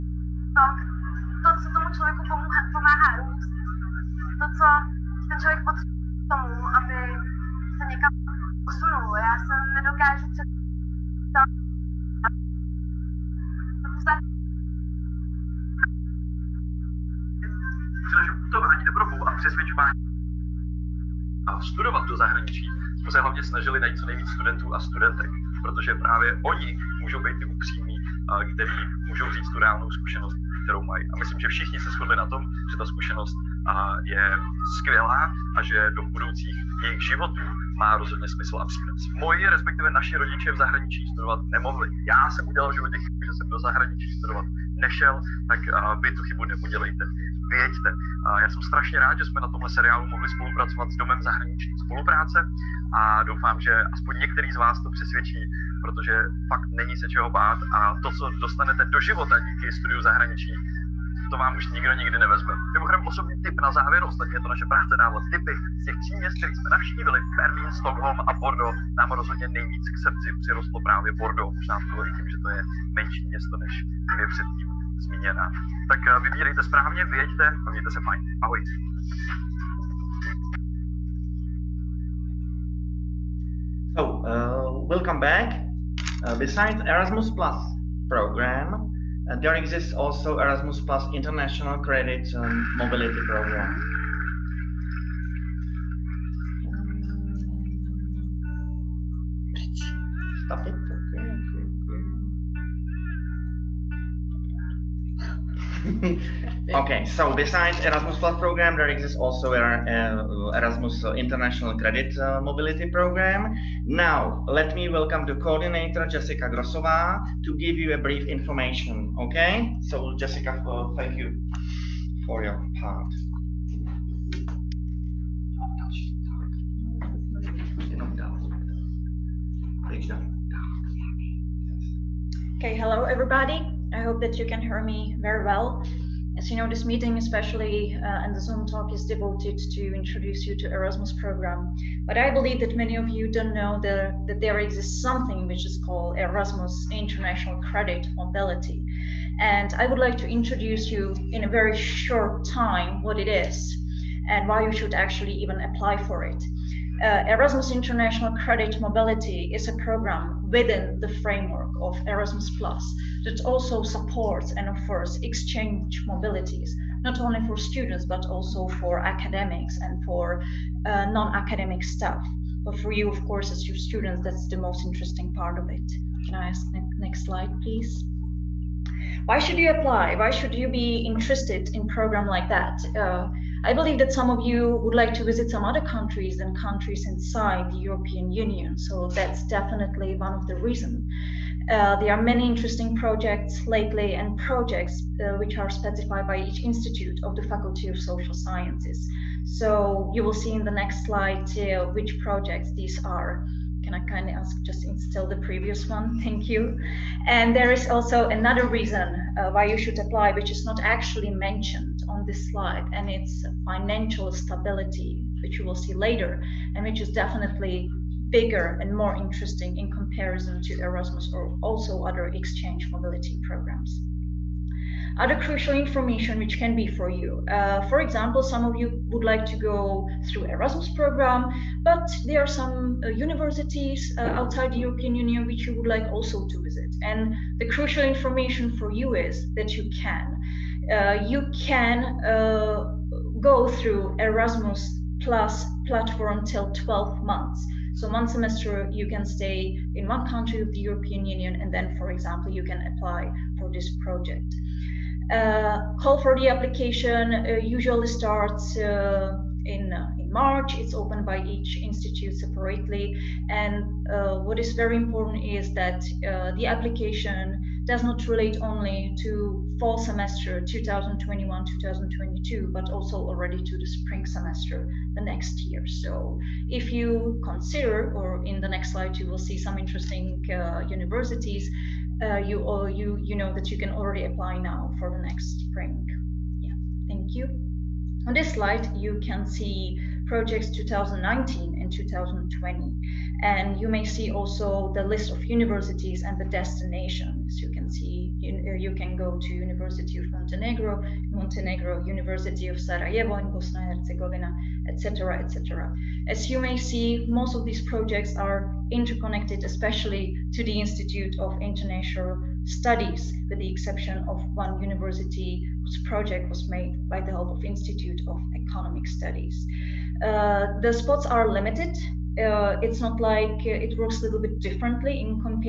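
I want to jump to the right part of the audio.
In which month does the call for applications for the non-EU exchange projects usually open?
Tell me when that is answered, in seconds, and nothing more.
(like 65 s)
260 s.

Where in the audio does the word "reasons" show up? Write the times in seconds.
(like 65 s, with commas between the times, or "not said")
190 s, 208 s.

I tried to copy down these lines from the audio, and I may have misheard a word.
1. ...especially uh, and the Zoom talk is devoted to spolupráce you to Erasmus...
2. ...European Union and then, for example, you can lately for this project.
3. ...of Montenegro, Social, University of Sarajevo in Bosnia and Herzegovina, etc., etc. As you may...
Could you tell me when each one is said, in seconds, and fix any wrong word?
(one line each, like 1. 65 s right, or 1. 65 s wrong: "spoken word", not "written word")
1. 137 s wrong: "introduce", not "spolupráce"
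2. 250 s wrong: "apply", not "lately"
3. 300 s wrong: "Montenegro", not "Social".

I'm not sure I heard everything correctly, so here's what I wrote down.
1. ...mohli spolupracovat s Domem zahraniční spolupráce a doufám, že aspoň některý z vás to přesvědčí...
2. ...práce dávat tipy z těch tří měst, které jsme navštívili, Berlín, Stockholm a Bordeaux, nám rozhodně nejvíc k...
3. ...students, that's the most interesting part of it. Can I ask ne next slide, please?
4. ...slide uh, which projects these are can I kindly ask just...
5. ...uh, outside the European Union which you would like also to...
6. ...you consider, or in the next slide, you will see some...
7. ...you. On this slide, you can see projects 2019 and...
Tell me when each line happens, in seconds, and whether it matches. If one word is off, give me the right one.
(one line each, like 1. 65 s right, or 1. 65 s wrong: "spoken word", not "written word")
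1. 50 s right
2. 64 s right
3. 173 s right
4. 201 s right
5. 234 s right
6. 276 s right
7. 287 s right.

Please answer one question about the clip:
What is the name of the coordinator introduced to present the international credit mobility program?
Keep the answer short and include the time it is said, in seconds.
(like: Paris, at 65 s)
Jessica Grosova, at 116 s.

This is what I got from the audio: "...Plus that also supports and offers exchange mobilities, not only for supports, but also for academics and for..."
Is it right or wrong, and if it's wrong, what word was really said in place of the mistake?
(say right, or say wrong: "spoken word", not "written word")
wrong: "students", not "supports".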